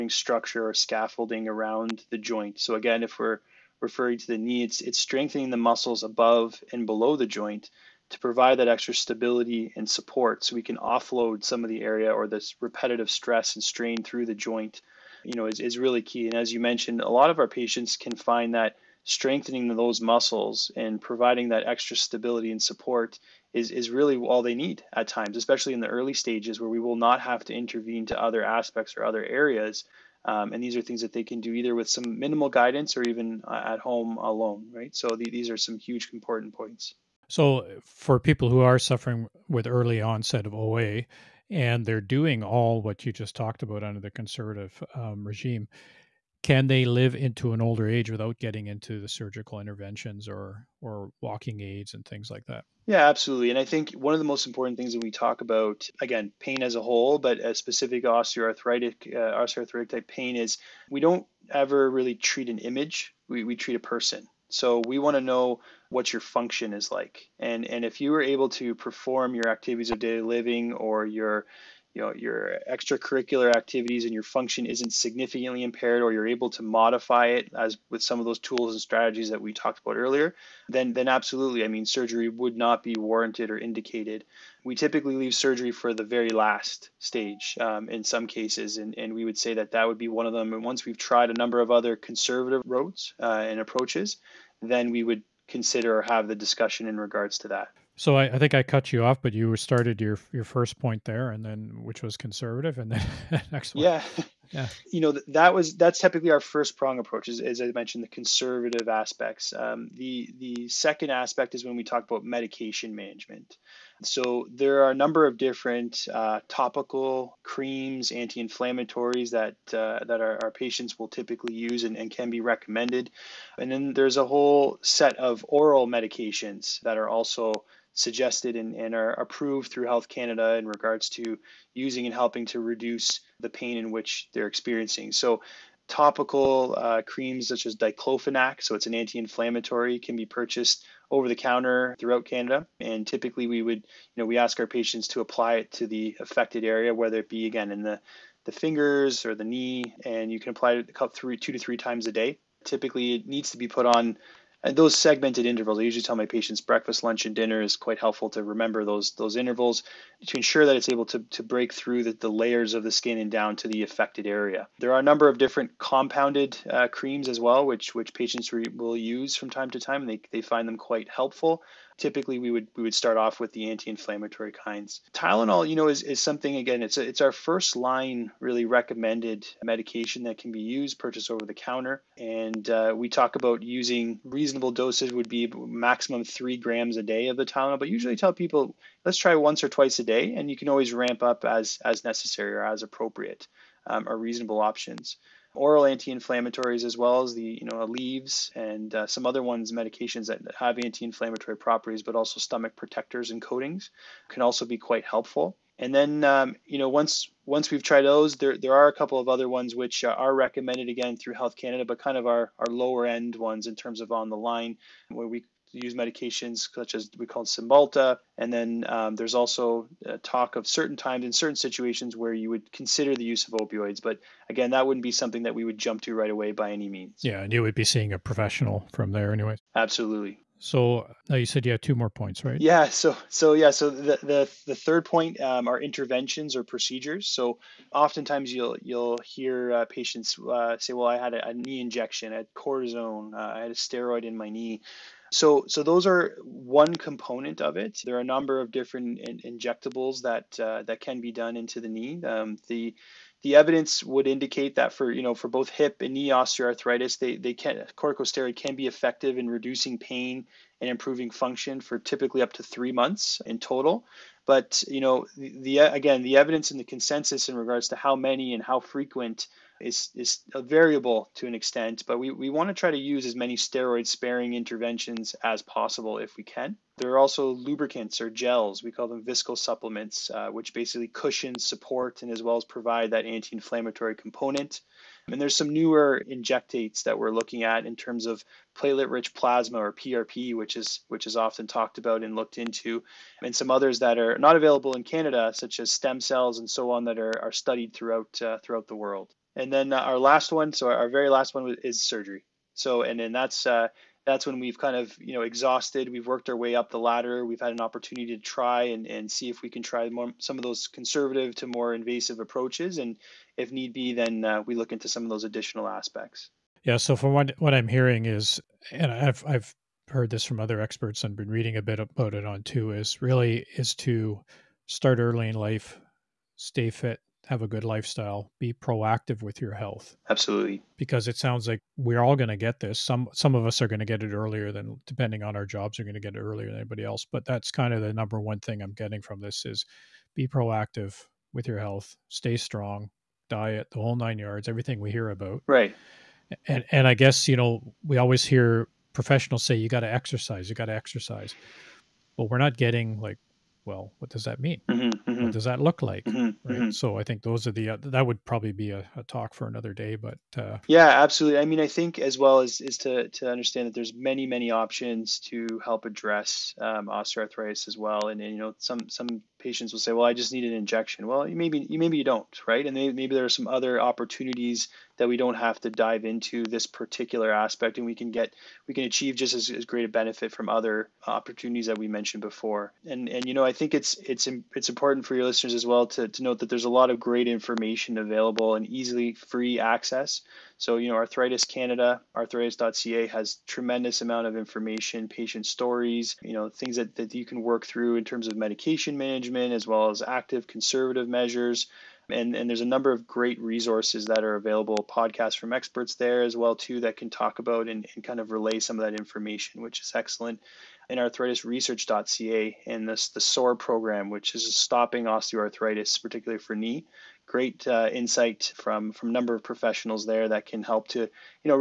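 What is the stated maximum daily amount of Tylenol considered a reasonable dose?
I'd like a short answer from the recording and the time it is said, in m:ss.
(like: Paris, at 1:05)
3 grams, at 3:06.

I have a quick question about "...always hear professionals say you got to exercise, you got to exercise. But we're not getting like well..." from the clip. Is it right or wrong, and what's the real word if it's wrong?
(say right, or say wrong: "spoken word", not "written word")
right.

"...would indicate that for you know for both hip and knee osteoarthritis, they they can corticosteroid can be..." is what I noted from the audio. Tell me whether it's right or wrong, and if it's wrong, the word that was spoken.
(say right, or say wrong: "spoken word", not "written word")
right.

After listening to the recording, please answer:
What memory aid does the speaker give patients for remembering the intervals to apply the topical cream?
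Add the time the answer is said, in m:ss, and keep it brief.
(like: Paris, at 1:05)
breakfast, lunch, and dinner, at 2:36.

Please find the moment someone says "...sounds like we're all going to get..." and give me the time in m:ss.
5:31.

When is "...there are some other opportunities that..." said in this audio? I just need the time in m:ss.
6:13.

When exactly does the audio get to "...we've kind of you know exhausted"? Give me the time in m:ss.
5:04.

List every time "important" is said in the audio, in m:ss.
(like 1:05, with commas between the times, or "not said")
0:36, 0:54, 6:24.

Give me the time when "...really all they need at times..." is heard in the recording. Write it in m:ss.
0:23.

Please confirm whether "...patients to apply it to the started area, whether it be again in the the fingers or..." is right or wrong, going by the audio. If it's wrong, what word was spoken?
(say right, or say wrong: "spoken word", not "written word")
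wrong: "affected", not "started".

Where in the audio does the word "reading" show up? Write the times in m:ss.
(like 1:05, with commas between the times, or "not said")
5:21.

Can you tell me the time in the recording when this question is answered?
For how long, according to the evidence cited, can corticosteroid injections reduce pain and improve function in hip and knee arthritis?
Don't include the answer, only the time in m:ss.
4:22.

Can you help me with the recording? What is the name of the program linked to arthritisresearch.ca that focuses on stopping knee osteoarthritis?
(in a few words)
SOAR.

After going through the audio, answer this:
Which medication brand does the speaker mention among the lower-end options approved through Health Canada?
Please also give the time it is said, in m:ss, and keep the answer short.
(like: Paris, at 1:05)
Cymbalta, at 3:37.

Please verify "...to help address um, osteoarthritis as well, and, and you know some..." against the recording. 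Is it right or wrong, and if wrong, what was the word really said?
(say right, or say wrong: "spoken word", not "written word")
right.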